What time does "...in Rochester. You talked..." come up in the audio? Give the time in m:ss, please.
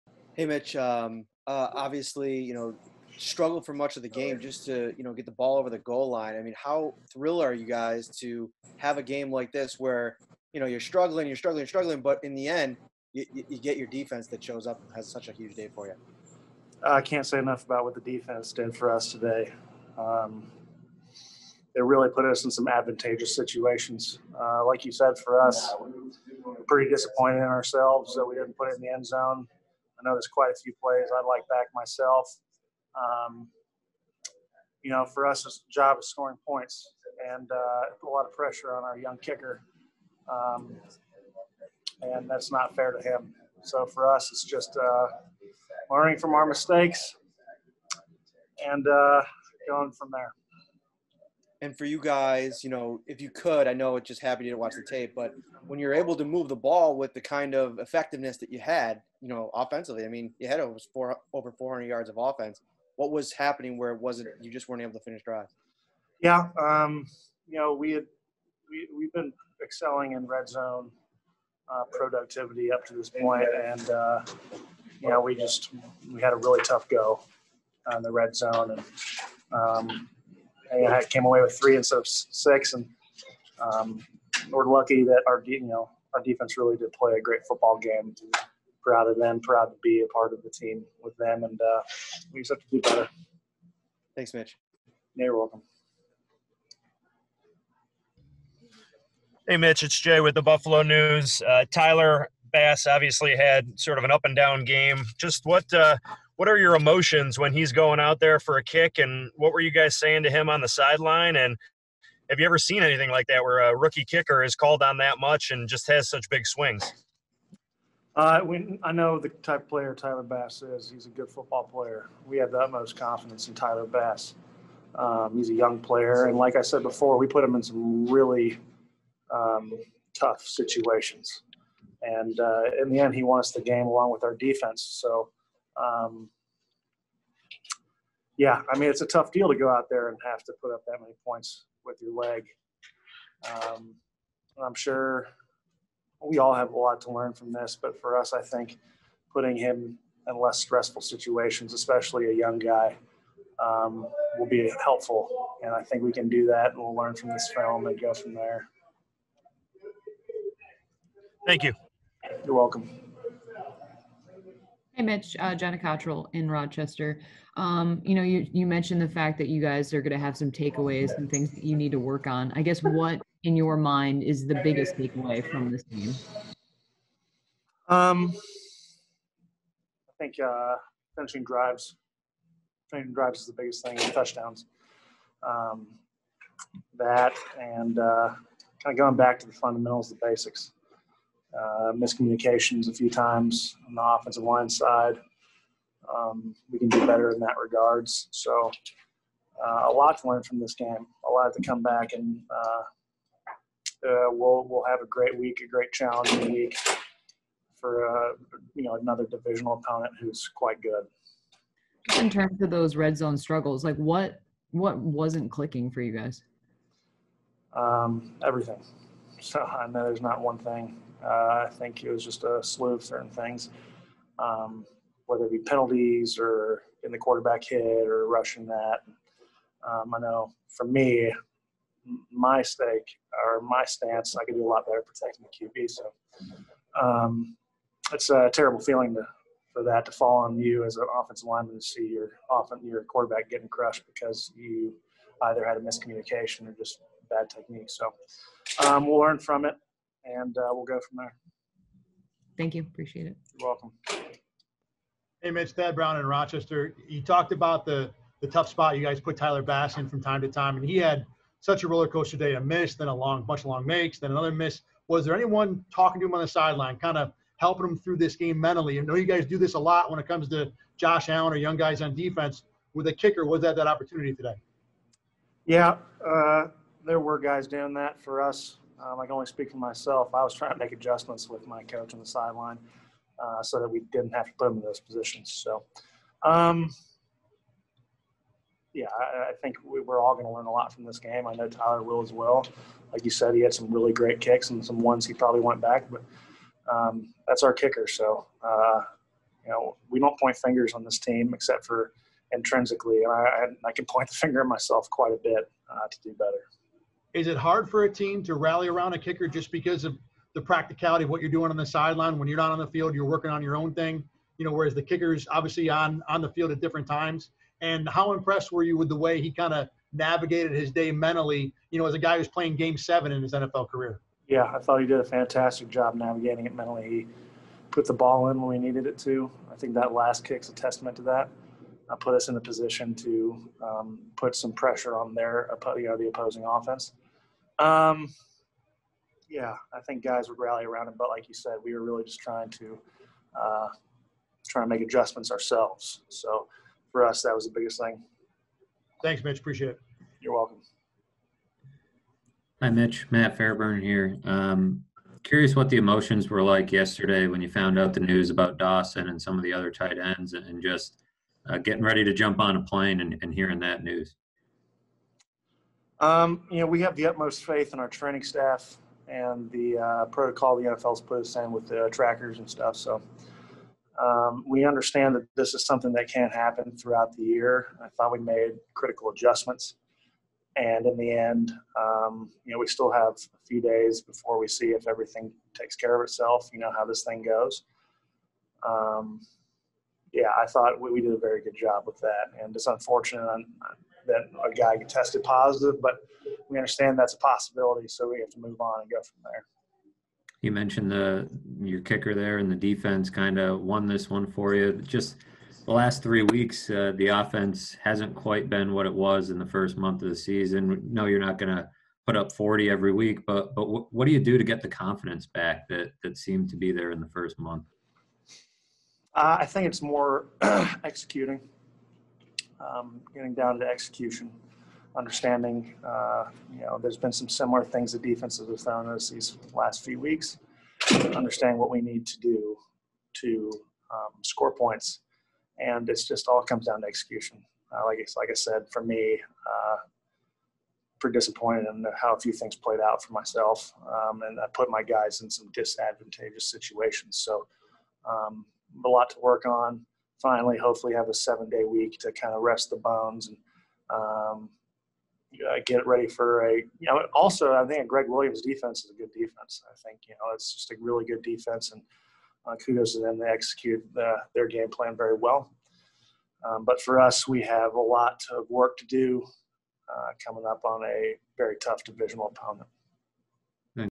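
4:16.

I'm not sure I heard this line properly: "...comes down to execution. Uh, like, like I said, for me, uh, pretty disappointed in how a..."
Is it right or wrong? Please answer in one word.
right.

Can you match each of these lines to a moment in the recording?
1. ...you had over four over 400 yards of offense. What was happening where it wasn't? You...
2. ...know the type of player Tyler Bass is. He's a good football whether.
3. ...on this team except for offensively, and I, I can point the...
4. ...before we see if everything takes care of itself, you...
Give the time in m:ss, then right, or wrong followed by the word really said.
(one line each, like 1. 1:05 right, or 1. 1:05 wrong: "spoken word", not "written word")
1. 1:00 right
2. 1:58 wrong: "player", not "whether"
3. 5:00 wrong: "intrinsically", not "offensively"
4. 6:24 right.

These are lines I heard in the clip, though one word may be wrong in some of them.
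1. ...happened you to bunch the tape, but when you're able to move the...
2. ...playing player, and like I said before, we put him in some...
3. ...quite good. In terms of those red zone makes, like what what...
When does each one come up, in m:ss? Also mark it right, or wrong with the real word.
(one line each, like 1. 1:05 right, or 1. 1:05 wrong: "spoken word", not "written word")
1. 0:54 wrong: "watch", not "bunch"
2. 2:05 wrong: "young", not "playing"
3. 3:30 wrong: "struggles", not "makes".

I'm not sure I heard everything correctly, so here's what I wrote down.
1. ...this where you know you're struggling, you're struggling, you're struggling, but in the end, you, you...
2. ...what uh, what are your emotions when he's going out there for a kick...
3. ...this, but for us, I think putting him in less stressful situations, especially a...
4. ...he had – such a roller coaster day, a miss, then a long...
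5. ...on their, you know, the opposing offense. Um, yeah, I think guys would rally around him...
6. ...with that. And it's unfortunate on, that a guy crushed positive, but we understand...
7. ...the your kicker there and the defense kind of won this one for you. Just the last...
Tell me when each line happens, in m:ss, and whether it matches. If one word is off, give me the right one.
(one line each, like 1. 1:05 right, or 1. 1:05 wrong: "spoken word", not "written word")
1. 0:09 right
2. 1:45 right
3. 2:27 right
4. 4:20 right
5. 5:35 right
6. 6:32 wrong: "tested", not "crushed"
7. 6:41 right.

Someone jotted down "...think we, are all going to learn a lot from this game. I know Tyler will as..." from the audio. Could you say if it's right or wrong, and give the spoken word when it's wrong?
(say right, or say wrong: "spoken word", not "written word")
right.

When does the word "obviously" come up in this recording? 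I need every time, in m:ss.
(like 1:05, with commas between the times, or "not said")
0:01, 1:42, 5:15.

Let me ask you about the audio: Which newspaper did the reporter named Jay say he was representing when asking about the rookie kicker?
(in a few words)
Buffalo News.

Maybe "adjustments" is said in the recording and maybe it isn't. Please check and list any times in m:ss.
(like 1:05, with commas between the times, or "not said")
4:40, 5:45, 6:19.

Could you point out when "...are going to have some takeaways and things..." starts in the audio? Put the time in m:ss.
2:49.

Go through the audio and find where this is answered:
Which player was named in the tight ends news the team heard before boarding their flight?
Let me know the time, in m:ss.
5:58.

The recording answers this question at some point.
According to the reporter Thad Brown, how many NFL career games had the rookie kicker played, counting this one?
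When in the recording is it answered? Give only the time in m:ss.
5:22.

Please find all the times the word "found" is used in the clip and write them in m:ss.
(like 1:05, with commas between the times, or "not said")
5:57, 7:08.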